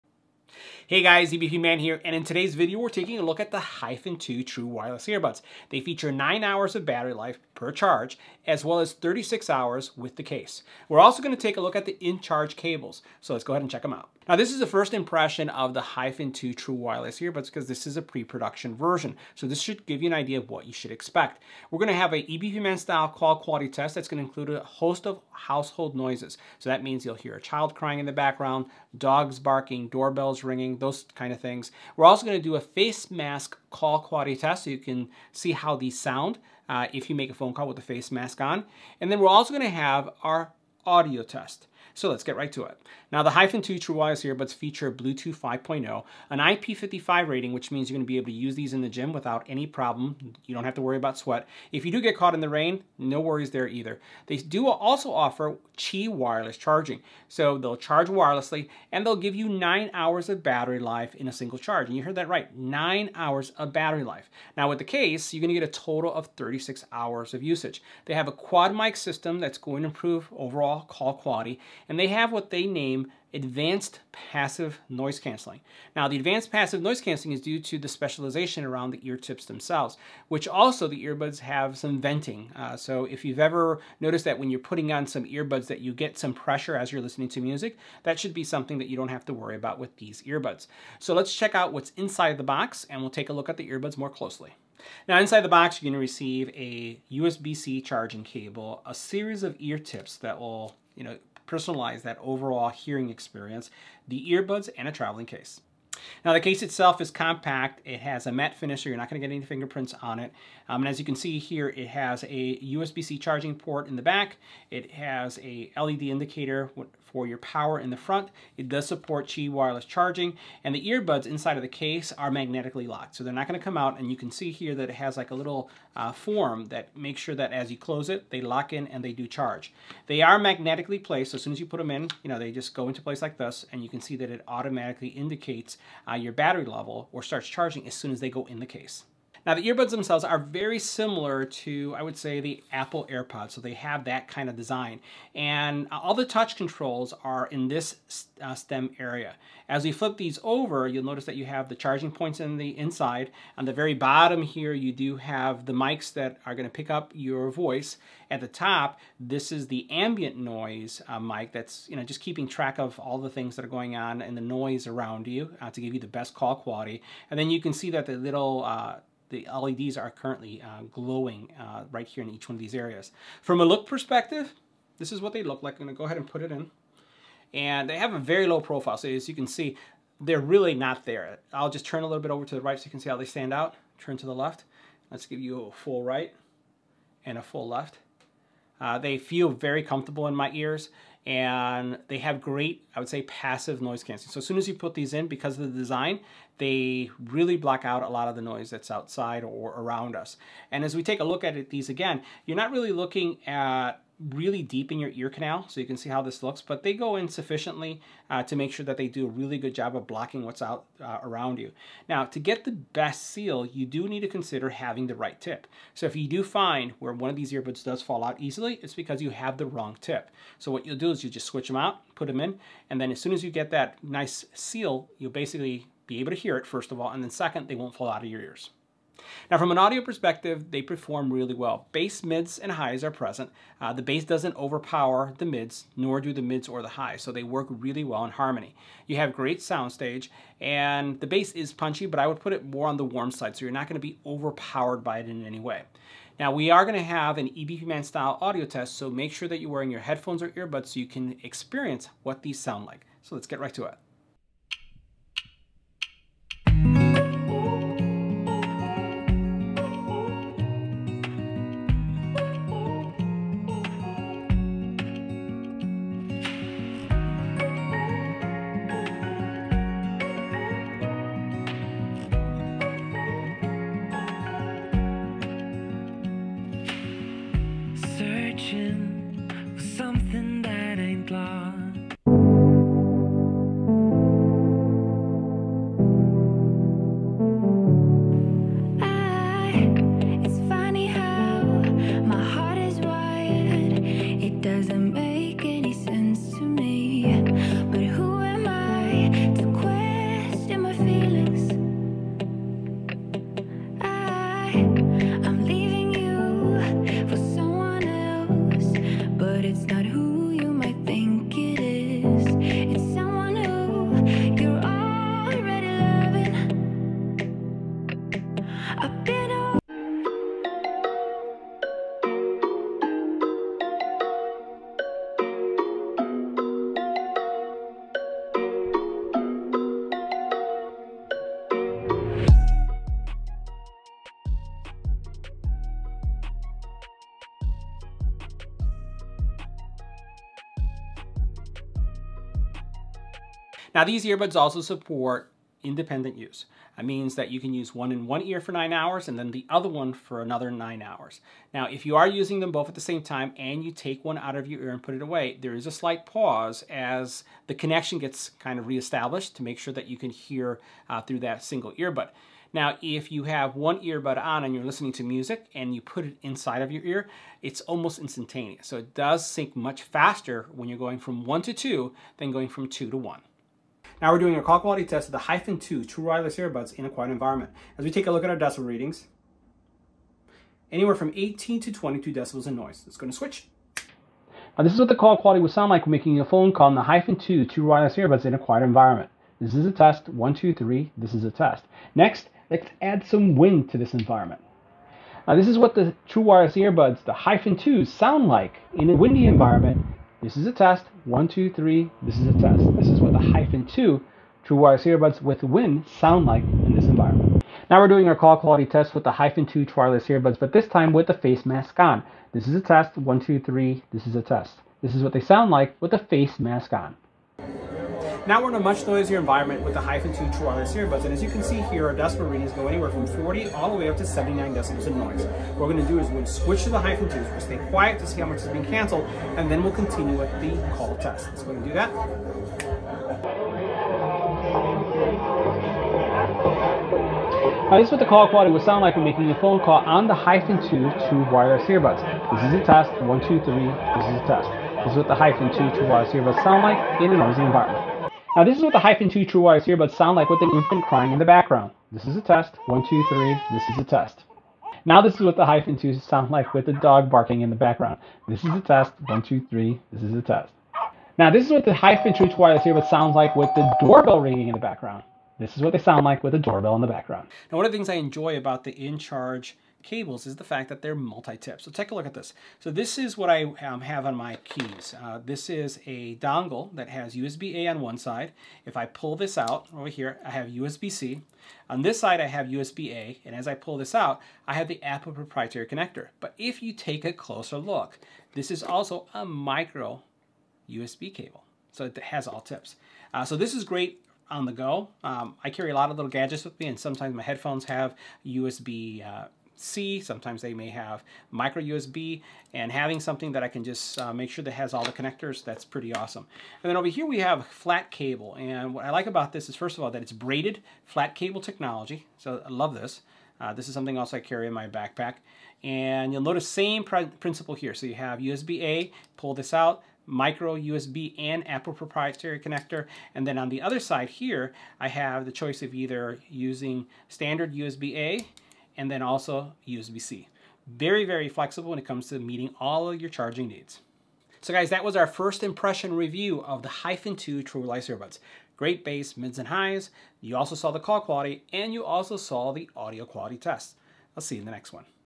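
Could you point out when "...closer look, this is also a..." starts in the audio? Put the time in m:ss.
8:07.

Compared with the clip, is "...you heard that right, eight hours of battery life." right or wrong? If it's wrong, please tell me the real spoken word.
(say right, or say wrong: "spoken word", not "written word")
wrong: "nine", not "eight".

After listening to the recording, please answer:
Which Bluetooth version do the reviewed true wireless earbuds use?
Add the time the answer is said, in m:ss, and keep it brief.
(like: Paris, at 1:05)
5.0, at 0:44.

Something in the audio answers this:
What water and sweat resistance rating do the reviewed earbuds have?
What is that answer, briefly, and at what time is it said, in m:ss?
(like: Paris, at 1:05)
IP55, at 0:46.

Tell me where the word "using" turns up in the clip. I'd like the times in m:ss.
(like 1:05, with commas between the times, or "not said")
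5:52, 8:46.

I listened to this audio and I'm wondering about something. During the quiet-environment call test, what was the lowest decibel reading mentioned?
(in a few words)
18 decibels.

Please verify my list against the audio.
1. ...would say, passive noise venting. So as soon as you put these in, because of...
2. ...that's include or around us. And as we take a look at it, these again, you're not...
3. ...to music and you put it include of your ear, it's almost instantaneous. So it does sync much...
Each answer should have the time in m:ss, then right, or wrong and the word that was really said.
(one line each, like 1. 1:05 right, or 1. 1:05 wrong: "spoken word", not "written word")
1. 3:12 wrong: "canceling", not "venting"
2. 3:18 wrong: "outside", not "include"
3. 6:05 wrong: "inside", not "include".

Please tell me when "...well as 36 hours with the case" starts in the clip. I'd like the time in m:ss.
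0:08.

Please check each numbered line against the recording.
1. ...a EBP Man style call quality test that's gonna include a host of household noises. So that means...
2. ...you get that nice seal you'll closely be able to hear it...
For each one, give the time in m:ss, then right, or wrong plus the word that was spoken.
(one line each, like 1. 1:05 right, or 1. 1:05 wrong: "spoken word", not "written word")
1. 0:22 right
2. 3:43 wrong: "basically", not "closely".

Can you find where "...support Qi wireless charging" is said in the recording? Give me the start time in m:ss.
1:58.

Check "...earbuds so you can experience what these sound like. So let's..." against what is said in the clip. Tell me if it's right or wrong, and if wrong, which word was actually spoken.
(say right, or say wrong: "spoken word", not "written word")
right.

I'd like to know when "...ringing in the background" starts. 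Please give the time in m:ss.
7:44.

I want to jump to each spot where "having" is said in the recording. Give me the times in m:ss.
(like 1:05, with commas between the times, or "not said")
3:34, 8:22.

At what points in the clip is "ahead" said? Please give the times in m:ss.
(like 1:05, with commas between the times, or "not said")
0:13, 2:56.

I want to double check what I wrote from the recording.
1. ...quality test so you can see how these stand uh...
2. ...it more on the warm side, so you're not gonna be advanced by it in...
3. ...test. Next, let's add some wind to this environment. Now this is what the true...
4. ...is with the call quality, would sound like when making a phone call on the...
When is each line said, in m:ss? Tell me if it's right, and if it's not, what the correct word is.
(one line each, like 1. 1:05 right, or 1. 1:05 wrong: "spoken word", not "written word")
1. 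0:34 wrong: "sound", not "stand"
2. 4:02 wrong: "overpowered", not "advanced"
3. 6:31 right
4. 7:18 right.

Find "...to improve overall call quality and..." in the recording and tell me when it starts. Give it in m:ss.
1:09.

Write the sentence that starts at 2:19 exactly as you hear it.
Now the earbuds themselves are very similar to, I would say, the Apple AirPods.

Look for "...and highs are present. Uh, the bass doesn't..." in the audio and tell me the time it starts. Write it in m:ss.
3:52.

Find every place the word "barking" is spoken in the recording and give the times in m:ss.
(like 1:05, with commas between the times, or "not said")
0:29, 7:37.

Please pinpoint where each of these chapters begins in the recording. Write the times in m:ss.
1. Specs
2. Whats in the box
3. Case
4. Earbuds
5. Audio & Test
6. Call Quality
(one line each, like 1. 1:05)
1. 0:43
2. 1:35
3. 1:46
4. 2:10
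5. 3:50
6. 6:15.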